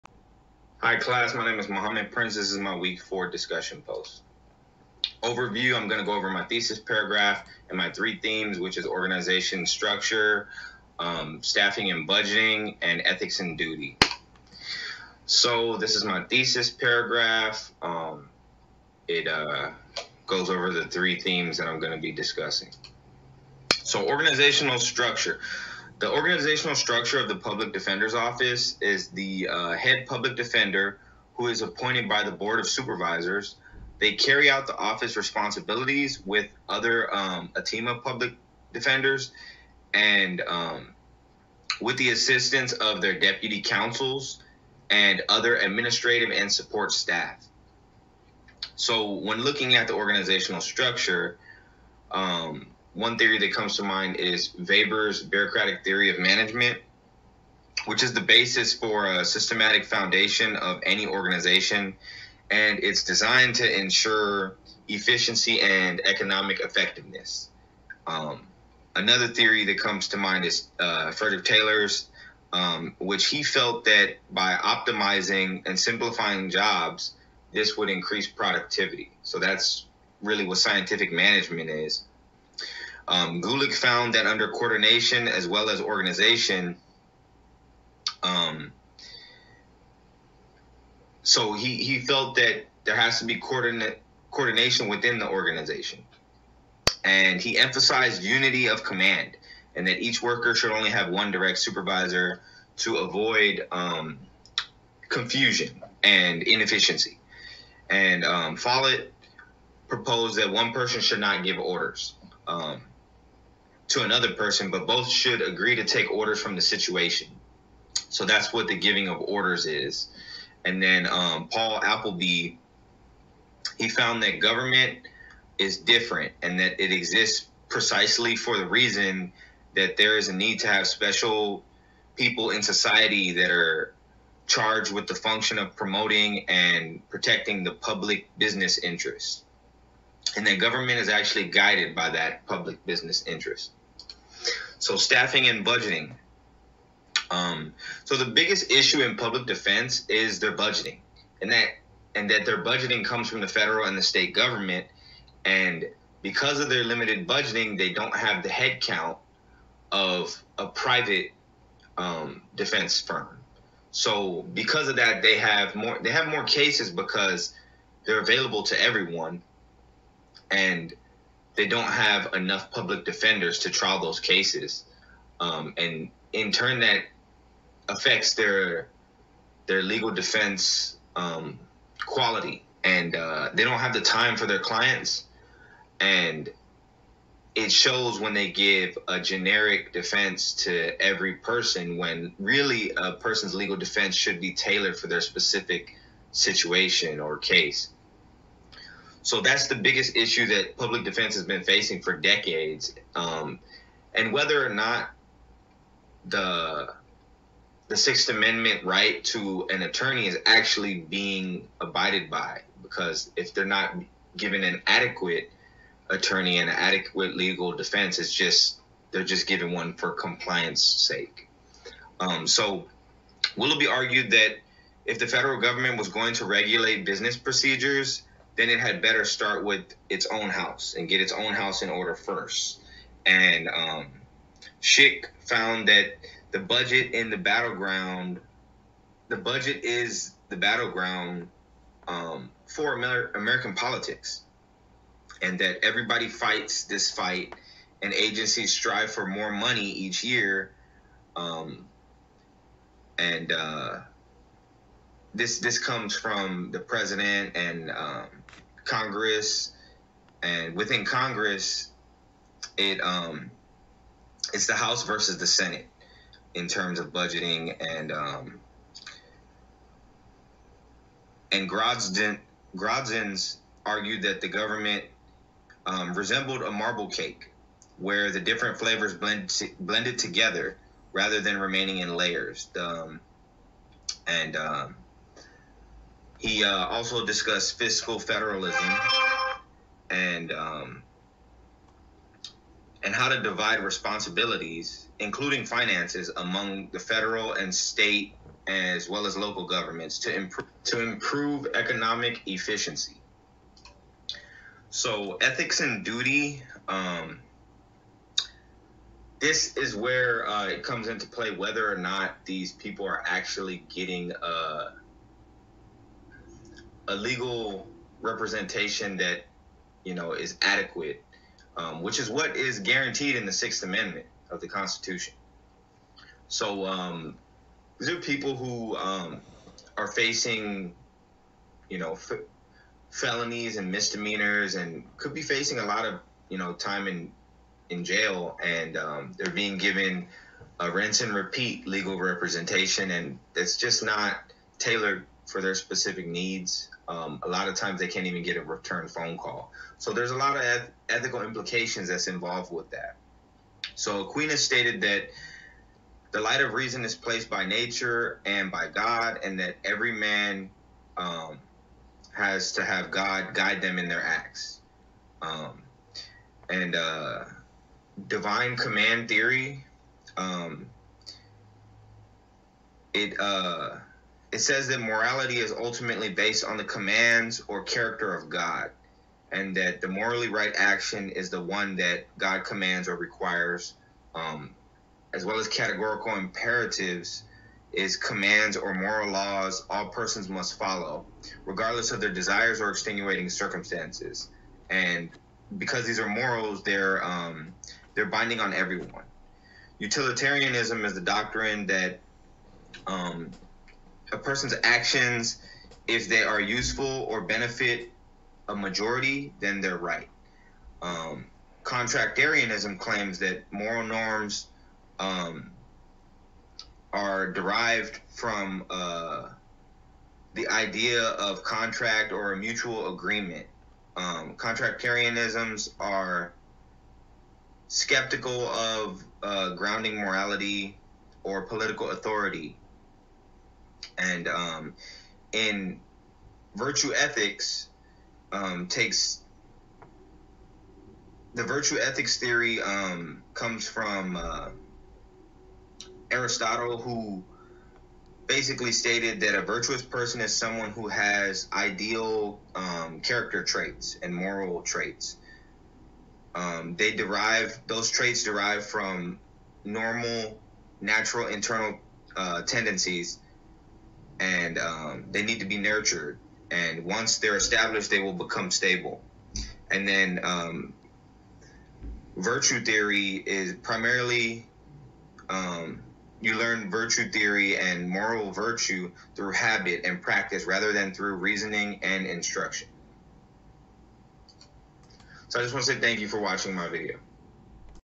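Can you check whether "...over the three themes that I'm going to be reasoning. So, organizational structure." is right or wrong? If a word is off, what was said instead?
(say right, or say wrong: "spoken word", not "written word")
wrong: "discussing", not "reasoning".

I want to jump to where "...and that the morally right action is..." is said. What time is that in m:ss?
6:19.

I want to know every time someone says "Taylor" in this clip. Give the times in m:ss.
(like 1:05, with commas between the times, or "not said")
1:11.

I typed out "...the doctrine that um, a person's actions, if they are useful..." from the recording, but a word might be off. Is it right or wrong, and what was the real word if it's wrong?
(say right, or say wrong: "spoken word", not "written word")
right.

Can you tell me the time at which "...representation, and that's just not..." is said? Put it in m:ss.
5:42.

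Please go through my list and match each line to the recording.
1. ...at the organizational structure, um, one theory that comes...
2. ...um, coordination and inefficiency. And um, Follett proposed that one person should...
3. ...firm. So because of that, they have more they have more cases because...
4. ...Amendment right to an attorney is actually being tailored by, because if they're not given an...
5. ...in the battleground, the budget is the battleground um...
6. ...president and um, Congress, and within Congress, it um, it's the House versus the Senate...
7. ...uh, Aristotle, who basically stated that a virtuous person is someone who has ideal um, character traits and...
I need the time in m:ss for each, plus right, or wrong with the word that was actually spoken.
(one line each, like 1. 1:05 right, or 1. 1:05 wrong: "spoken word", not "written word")
1. 0:49 right
2. 1:43 wrong: "confusion", not "coordination"
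3. 2:42 right
4. 3:28 wrong: "abided", not "tailored"
5. 3:57 right
6. 4:16 right
7. 7:24 right.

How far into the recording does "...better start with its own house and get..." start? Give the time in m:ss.
3:49.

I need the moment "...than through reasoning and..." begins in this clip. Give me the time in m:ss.
8:00.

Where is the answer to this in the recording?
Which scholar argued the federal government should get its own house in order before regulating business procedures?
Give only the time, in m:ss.
3:43.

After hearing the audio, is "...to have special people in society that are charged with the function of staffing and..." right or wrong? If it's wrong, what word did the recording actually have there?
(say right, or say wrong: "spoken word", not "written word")
wrong: "promoting", not "staffing".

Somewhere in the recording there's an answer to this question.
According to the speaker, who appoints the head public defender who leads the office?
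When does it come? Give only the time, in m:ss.
0:32.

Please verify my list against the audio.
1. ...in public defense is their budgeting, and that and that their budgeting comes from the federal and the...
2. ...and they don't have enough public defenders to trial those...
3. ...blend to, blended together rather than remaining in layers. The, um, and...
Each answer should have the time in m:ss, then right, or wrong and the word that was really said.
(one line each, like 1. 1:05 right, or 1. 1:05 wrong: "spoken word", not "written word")
1. 2:29 right
2. 2:50 right
3. 4:39 right.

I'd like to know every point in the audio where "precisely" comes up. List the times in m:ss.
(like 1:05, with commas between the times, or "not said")
2:07.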